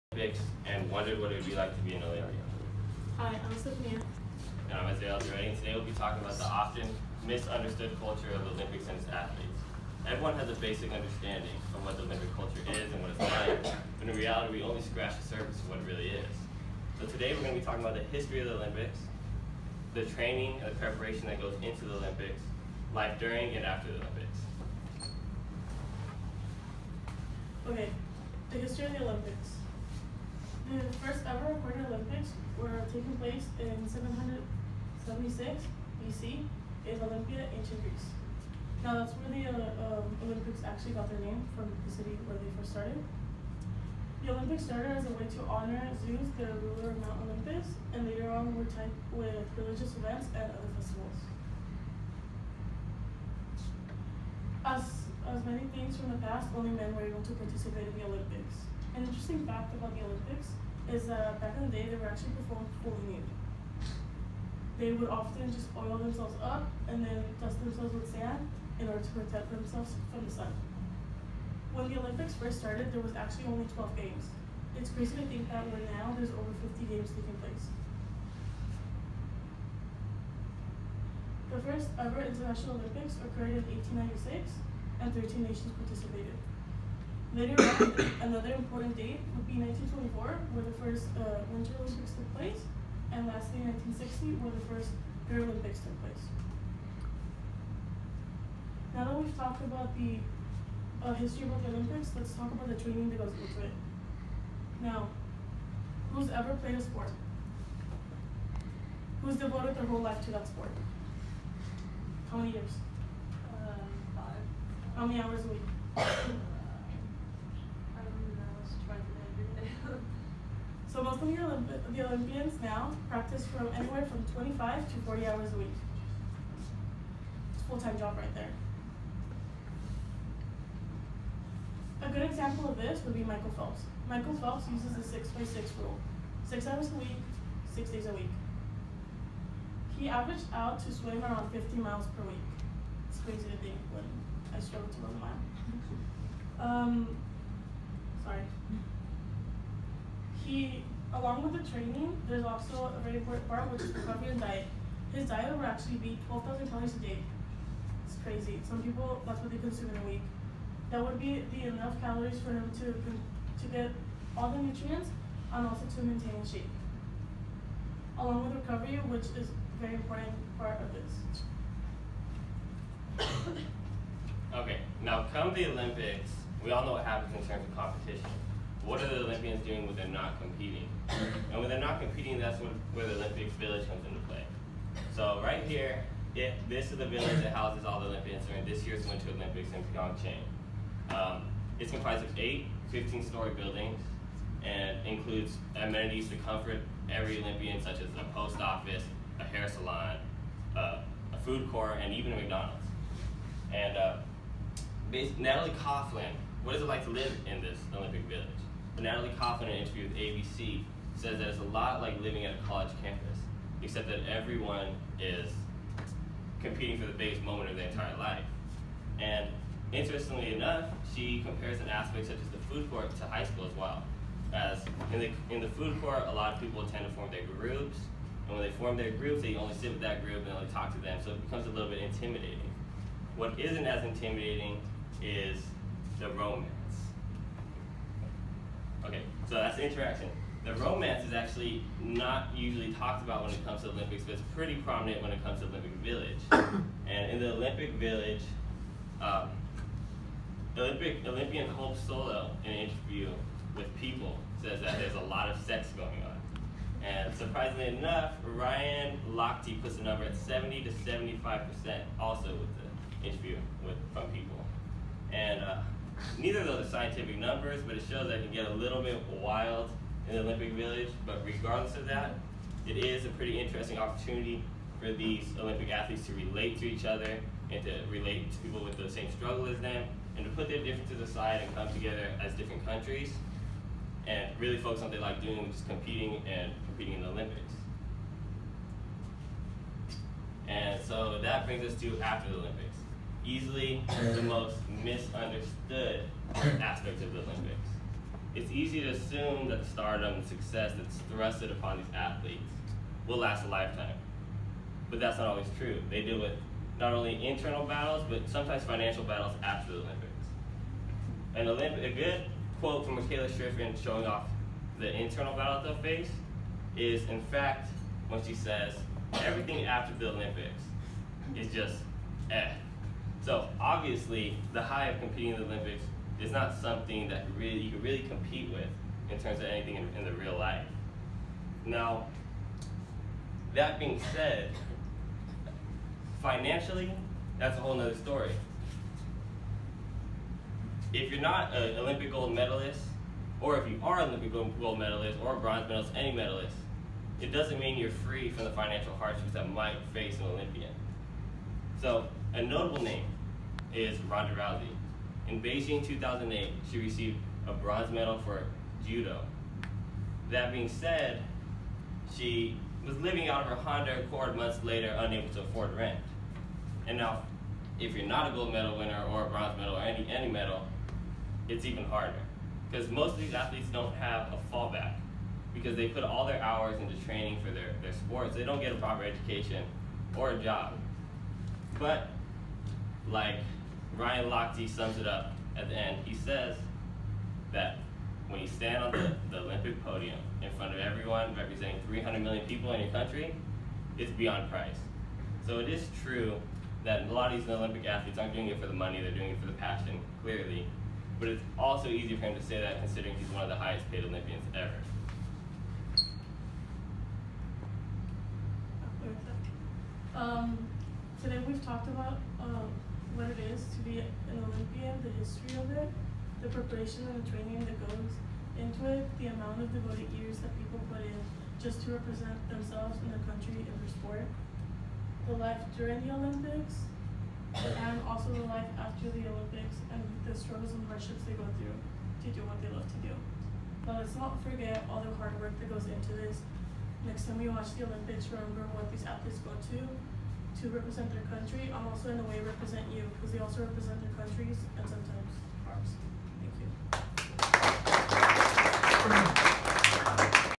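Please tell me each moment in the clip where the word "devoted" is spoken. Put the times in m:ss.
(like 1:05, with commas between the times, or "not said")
1:49, 6:59.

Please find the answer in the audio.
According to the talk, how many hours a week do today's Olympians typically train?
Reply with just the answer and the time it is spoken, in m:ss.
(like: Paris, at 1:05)
25 to 40 hours, at 2:04.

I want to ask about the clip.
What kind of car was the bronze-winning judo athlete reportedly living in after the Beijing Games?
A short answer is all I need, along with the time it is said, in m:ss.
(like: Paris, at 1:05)
Honda Accord, at 6:03.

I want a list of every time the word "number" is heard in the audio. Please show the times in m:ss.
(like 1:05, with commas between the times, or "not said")
4:20, 4:27.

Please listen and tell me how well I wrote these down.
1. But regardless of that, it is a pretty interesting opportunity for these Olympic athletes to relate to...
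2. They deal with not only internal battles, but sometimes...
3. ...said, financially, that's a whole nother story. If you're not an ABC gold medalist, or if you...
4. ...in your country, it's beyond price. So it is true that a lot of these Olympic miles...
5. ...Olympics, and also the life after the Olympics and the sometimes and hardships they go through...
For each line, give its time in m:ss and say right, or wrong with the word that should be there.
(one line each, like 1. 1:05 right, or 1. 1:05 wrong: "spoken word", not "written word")
1. 4:31 right
2. 5:06 right
3. 5:34 wrong: "Olympic", not "ABC"
4. 6:32 wrong: "athletes", not "miles"
5. 7:06 wrong: "struggles", not "sometimes".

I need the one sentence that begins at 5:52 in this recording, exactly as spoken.
So a notable name is Ronda Rousey.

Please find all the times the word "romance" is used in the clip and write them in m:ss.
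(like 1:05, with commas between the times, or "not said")
3:56, 4:00.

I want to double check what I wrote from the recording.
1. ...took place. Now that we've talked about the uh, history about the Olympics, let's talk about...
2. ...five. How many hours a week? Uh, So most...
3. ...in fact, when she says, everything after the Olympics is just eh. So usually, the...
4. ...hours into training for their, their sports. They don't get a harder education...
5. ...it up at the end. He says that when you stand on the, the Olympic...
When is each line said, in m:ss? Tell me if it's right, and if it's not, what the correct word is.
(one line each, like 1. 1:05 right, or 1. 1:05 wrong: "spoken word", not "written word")
1. 1:35 right
2. 1:54 right
3. 5:17 wrong: "obviously", not "usually"
4. 6:16 wrong: "proper", not "harder"
5. 6:25 right.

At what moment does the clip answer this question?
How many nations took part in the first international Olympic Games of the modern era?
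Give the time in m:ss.
1:25.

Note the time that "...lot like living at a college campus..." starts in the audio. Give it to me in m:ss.
3:31.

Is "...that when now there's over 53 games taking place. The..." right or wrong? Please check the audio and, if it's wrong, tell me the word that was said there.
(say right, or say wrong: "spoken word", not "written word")
wrong: "50", not "53".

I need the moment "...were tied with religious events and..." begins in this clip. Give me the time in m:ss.
0:48.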